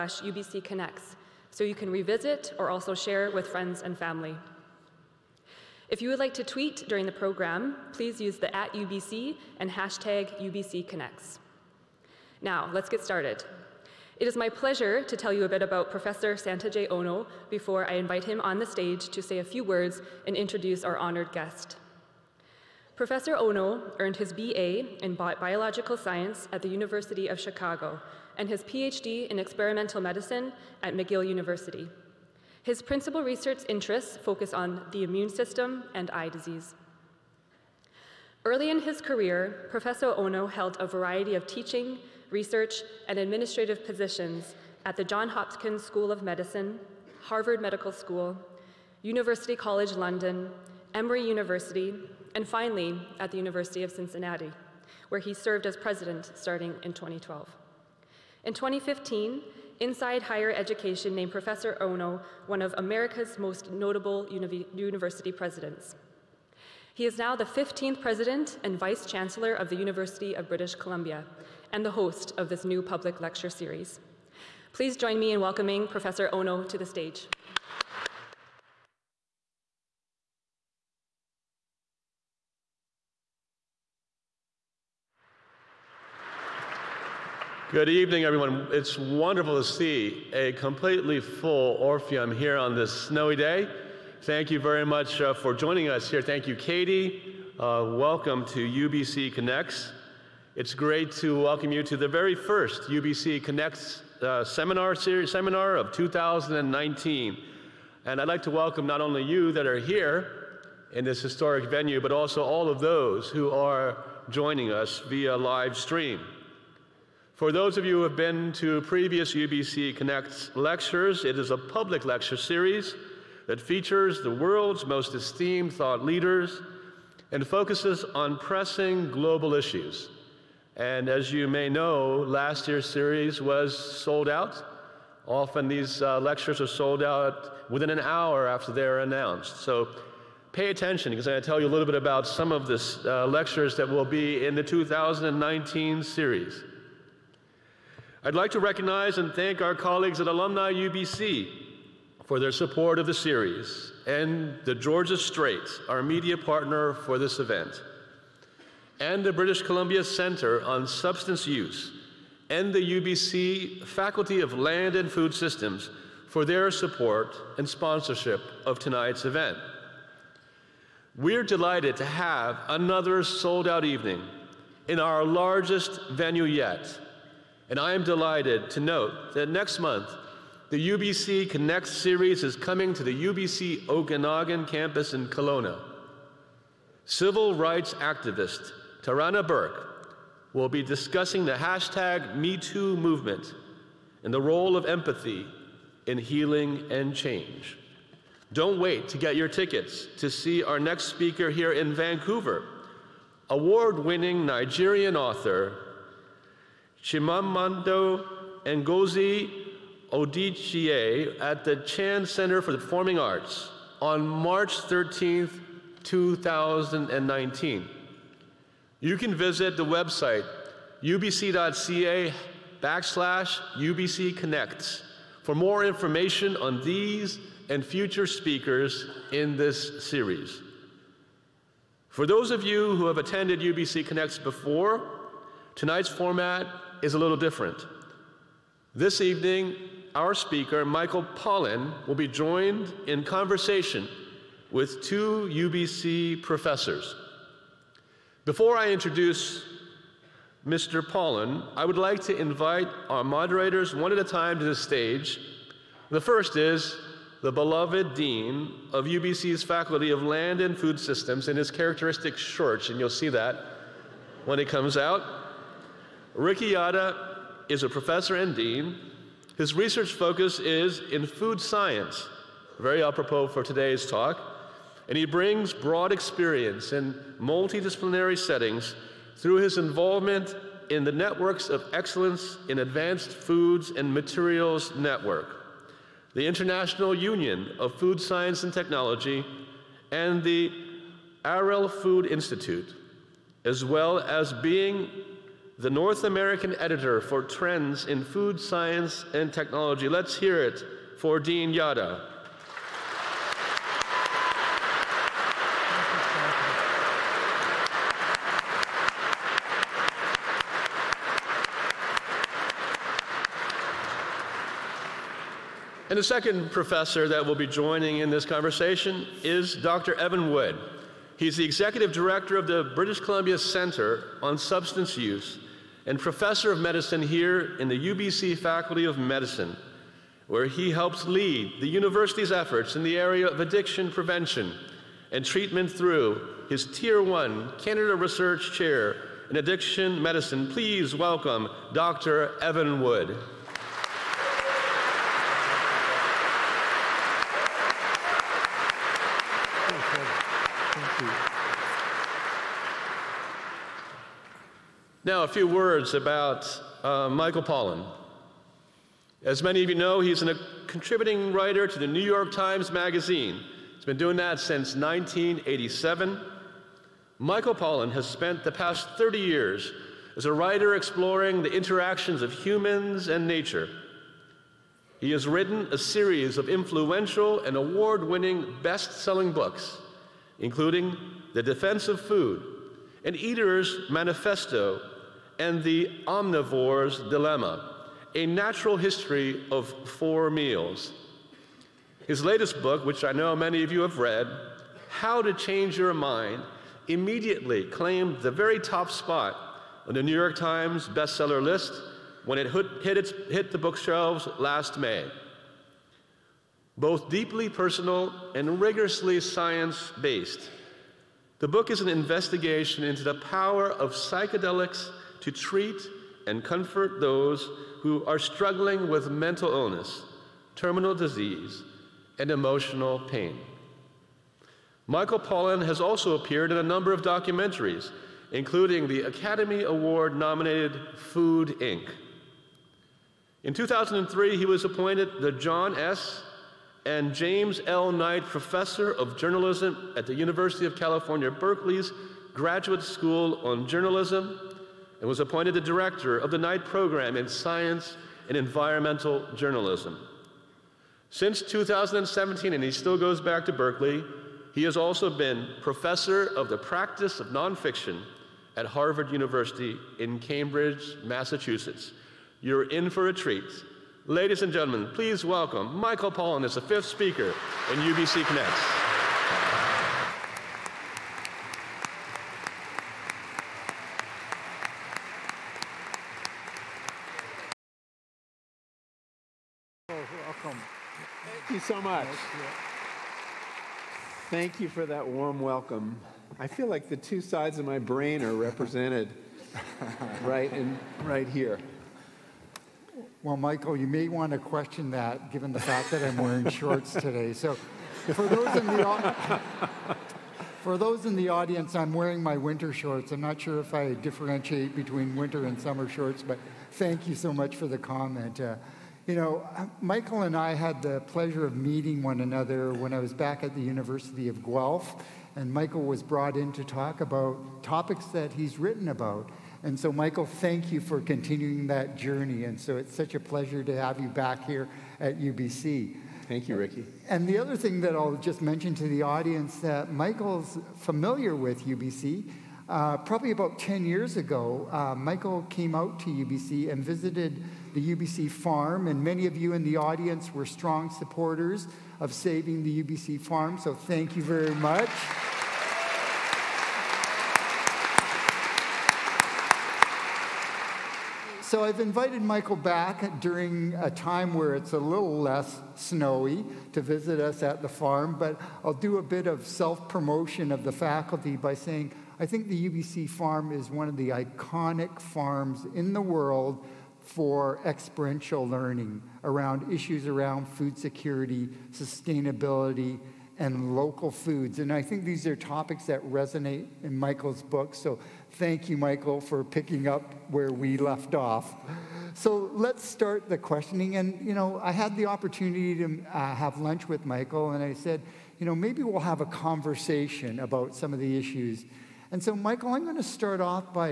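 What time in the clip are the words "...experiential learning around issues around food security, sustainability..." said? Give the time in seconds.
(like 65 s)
567 s.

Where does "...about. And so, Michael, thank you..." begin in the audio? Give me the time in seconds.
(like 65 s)
519 s.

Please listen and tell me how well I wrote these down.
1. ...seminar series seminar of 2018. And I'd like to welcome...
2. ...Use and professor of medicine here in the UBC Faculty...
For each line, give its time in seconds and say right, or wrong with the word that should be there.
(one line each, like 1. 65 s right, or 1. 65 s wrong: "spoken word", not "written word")
1. 104 s wrong: "2019", not "2018"
2. 325 s right.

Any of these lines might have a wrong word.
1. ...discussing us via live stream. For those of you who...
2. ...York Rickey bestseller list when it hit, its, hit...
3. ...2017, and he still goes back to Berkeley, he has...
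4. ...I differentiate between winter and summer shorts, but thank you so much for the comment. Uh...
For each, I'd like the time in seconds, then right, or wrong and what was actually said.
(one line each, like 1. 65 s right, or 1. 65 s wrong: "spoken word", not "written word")
1. 114 s wrong: "joining", not "discussing"
2. 400 s wrong: "Times", not "Rickey"
3. 451 s right
4. 503 s right.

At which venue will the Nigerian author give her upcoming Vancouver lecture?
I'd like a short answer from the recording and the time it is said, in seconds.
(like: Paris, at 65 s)
Chan Center for the Performing Arts, at 211 s.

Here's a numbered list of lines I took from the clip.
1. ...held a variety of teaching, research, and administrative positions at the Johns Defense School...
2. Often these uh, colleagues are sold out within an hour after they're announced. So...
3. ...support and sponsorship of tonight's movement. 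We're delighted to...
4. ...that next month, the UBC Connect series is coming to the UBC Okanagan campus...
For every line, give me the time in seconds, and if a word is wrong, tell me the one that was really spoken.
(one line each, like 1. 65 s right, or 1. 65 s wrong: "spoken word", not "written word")
1. 40 s wrong: "Hopkins", not "Defense"
2. 135 s wrong: "lectures", not "colleagues"
3. 166 s wrong: "event", not "movement"
4. 179 s right.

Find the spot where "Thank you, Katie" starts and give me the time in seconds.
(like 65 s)
96 s.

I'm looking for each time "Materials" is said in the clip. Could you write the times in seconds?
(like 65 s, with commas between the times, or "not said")
284 s.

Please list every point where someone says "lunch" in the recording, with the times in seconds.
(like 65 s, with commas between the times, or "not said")
586 s.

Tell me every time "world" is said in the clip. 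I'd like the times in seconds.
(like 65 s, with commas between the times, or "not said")
124 s, 566 s.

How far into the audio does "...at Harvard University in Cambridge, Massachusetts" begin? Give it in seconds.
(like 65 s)
458 s.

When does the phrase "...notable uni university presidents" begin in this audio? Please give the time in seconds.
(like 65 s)
63 s.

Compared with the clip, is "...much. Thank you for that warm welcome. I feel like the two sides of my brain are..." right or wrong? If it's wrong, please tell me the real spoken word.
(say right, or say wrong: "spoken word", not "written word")
right.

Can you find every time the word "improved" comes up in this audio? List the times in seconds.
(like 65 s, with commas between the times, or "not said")
not said.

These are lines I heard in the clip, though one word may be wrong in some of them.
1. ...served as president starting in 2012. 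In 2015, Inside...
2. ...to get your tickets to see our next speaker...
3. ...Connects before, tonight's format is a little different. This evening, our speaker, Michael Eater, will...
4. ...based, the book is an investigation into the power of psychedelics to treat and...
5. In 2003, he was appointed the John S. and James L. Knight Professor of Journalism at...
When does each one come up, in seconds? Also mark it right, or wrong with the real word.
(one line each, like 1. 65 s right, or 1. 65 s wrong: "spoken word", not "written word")
1. 55 s right
2. 199 s right
3. 234 s wrong: "Pollan", not "Eater"
4. 410 s right
5. 433 s right.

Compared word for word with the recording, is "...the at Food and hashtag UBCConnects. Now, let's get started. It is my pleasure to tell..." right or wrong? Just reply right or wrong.
wrong.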